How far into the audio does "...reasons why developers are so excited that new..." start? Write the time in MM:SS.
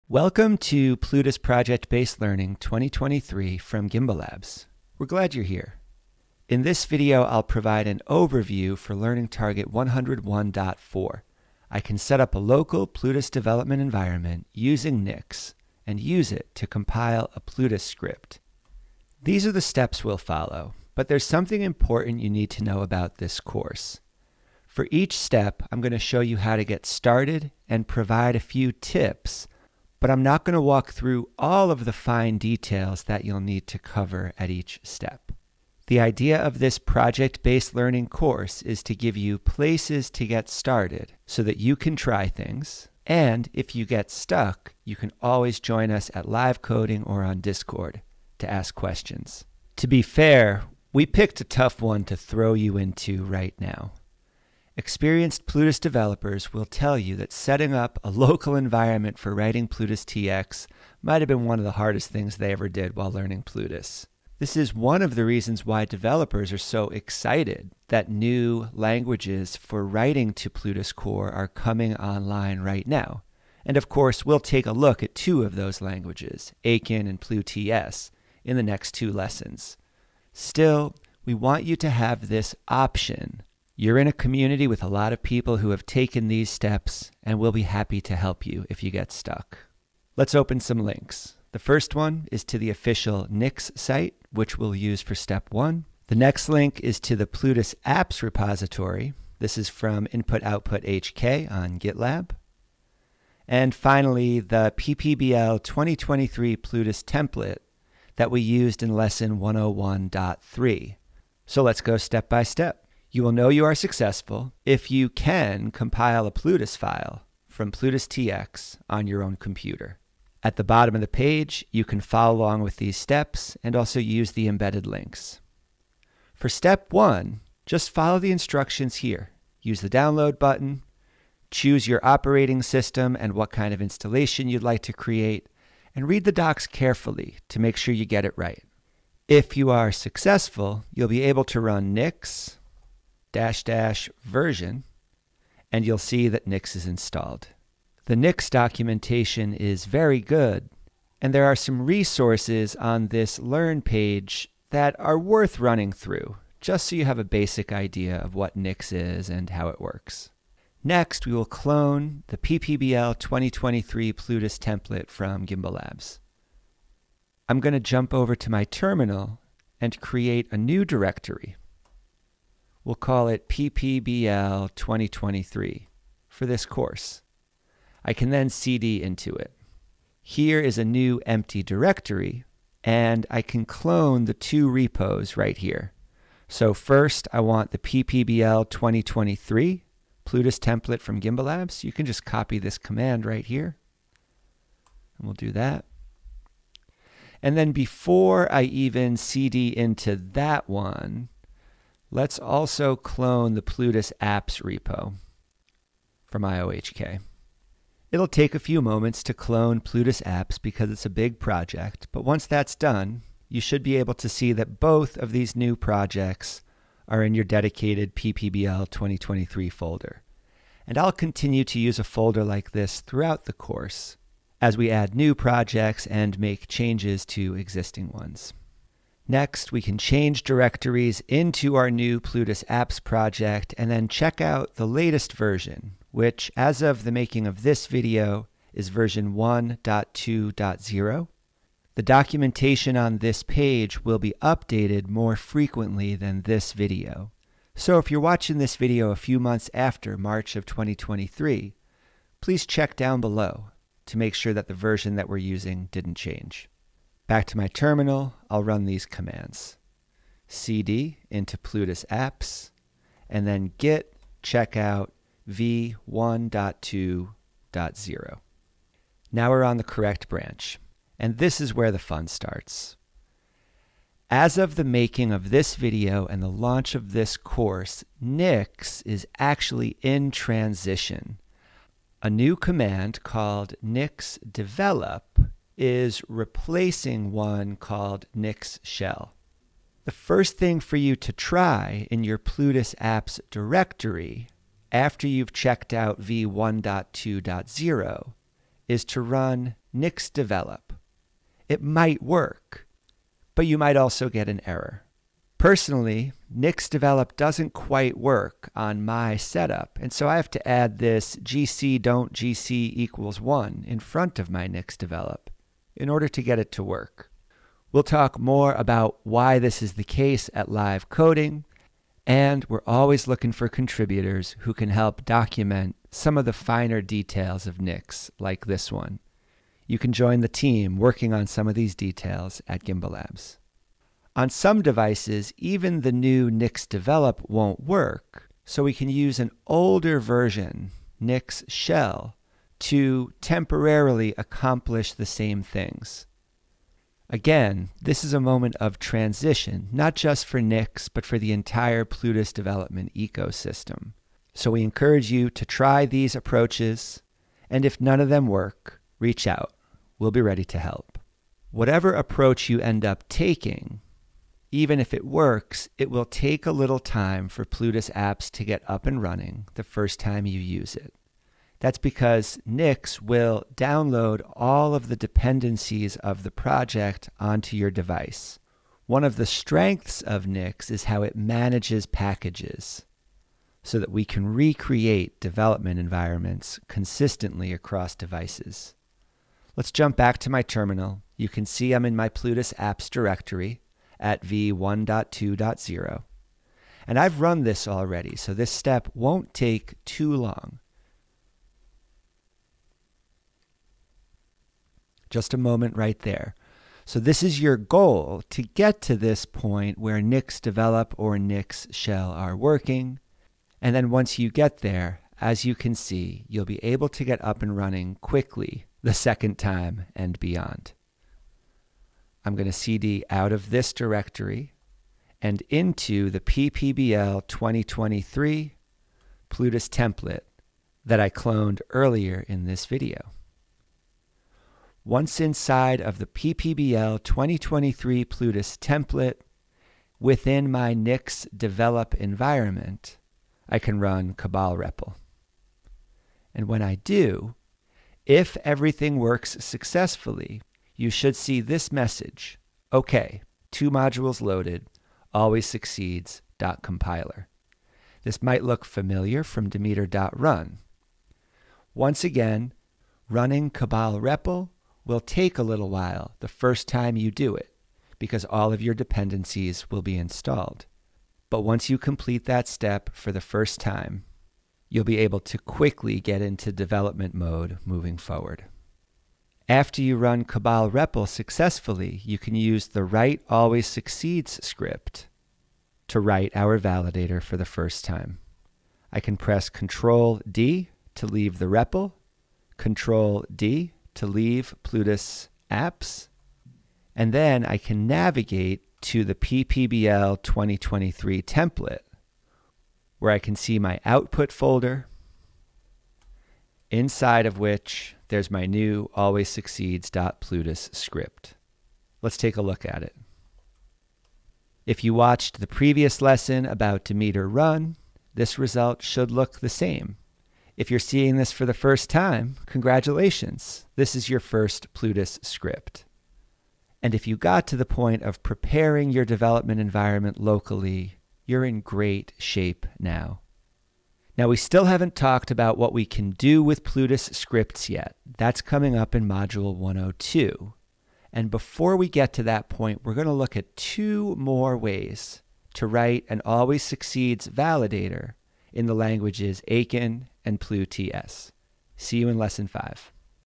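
01:05.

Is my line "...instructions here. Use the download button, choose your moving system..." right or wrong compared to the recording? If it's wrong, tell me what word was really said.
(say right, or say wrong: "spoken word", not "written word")
wrong: "operating", not "moving".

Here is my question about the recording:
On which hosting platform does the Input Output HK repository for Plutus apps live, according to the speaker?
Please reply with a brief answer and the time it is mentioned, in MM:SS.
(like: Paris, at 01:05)
GitLab, at 01:41.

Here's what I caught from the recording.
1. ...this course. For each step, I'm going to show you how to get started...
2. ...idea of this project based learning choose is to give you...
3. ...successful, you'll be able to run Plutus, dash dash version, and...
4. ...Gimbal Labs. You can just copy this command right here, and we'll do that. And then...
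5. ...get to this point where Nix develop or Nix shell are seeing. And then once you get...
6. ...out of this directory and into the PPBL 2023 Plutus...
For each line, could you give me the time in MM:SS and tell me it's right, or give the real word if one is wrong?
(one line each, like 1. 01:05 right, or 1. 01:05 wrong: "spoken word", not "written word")
1. 00:23 right
2. 00:35 wrong: "course", not "choose"
3. 02:19 wrong: "Nix", not "Plutus"
4. 03:11 right
5. 06:48 wrong: "working", not "seeing"
6. 07:03 right.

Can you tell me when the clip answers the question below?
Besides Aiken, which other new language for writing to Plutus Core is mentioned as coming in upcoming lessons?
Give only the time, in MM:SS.
01:17.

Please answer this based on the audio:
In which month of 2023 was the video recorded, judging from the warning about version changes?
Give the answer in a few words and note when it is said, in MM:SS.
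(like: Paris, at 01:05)
March, at 04:10.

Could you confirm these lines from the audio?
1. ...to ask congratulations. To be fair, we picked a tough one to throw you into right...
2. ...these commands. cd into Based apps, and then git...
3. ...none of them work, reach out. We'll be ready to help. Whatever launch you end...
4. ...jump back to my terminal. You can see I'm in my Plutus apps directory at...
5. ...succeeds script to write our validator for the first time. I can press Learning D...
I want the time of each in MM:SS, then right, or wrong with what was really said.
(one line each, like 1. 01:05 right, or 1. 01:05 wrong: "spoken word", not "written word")
1. 00:48 wrong: "questions", not "congratulations"
2. 04:18 wrong: "Plutus", not "Based"
3. 05:58 wrong: "approach", not "launch"
4. 06:29 right
5. 08:03 wrong: "Control", not "Learning".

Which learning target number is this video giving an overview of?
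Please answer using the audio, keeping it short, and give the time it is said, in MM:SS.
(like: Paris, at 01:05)
101.4, at 00:09.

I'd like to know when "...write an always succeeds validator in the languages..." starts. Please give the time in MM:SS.
09:05.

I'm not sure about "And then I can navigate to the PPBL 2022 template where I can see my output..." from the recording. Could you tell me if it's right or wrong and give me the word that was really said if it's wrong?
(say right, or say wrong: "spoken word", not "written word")
wrong: "2023", not "2022".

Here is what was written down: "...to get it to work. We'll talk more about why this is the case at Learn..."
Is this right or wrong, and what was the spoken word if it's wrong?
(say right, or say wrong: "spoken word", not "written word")
wrong: "Live", not "Learn".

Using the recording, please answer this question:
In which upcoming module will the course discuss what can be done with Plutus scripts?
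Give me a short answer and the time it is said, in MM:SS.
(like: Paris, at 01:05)
Module 102, at 08:59.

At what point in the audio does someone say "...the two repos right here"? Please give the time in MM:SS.
03:04.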